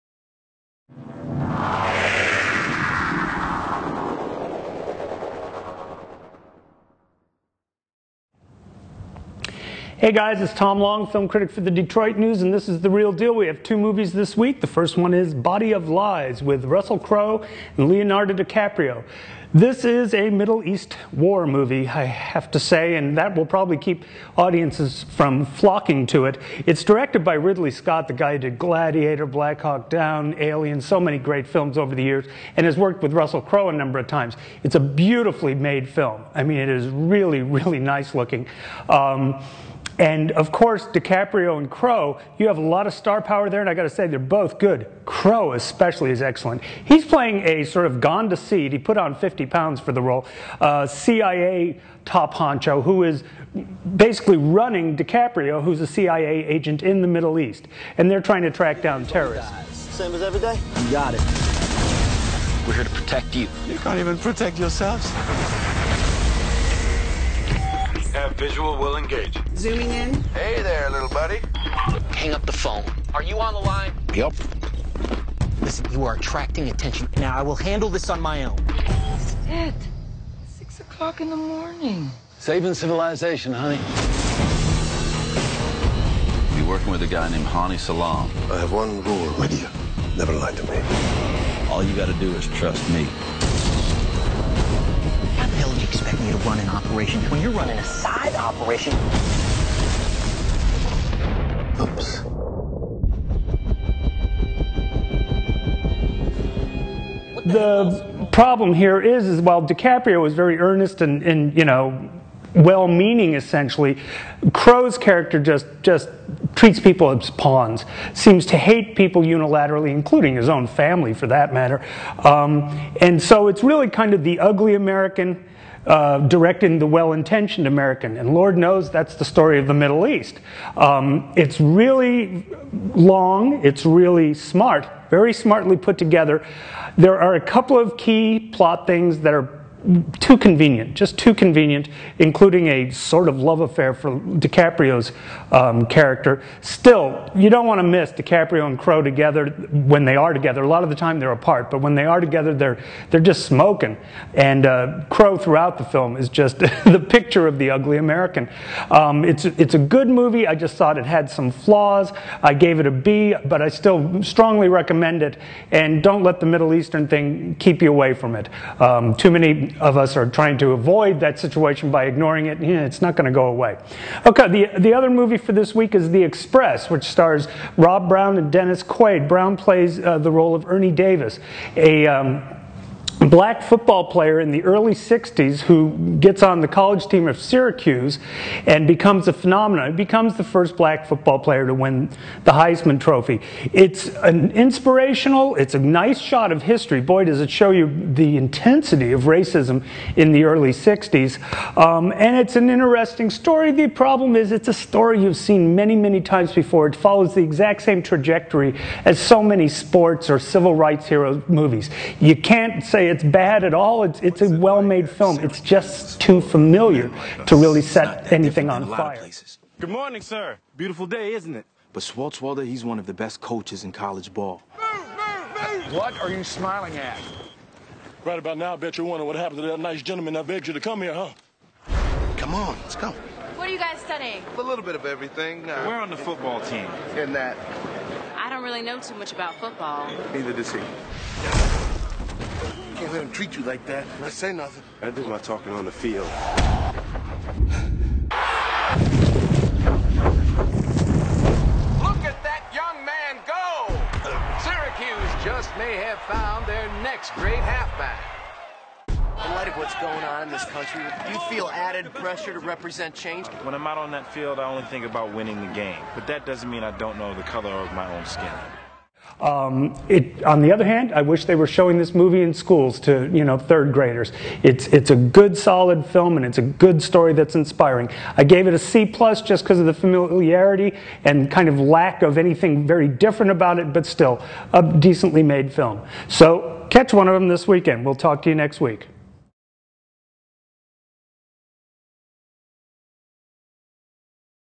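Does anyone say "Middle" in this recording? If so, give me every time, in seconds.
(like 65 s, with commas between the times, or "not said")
20 s, 57 s, 129 s, 166 s.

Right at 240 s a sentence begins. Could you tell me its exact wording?
Neither does he can't let him treat you like that.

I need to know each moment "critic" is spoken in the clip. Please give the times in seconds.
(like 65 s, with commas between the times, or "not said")
11 s.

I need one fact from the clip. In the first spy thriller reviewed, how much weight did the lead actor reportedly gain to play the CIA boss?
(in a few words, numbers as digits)
50 pounds.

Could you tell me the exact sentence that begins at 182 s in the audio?
Um, black football player in the early 60s who gets on the college team of Syracuse and becomes a phenomenon.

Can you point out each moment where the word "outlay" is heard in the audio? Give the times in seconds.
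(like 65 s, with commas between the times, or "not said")
not said.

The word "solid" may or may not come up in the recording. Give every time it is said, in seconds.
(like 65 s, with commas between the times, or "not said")
275 s.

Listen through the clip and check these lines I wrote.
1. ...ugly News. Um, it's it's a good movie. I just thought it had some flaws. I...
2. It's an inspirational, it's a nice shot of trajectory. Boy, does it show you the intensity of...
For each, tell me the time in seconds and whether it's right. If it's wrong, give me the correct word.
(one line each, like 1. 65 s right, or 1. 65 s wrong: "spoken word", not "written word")
1. 157 s wrong: "American", not "News"
2. 193 s wrong: "history", not "trajectory".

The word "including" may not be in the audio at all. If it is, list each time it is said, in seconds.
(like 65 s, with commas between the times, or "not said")
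119 s, 142 s.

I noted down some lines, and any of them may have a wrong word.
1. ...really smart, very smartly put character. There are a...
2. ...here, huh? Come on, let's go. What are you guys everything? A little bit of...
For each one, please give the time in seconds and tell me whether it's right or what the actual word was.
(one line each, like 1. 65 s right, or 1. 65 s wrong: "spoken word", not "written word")
1. 133 s wrong: "together", not "character"
2. 231 s wrong: "studying", not "everything".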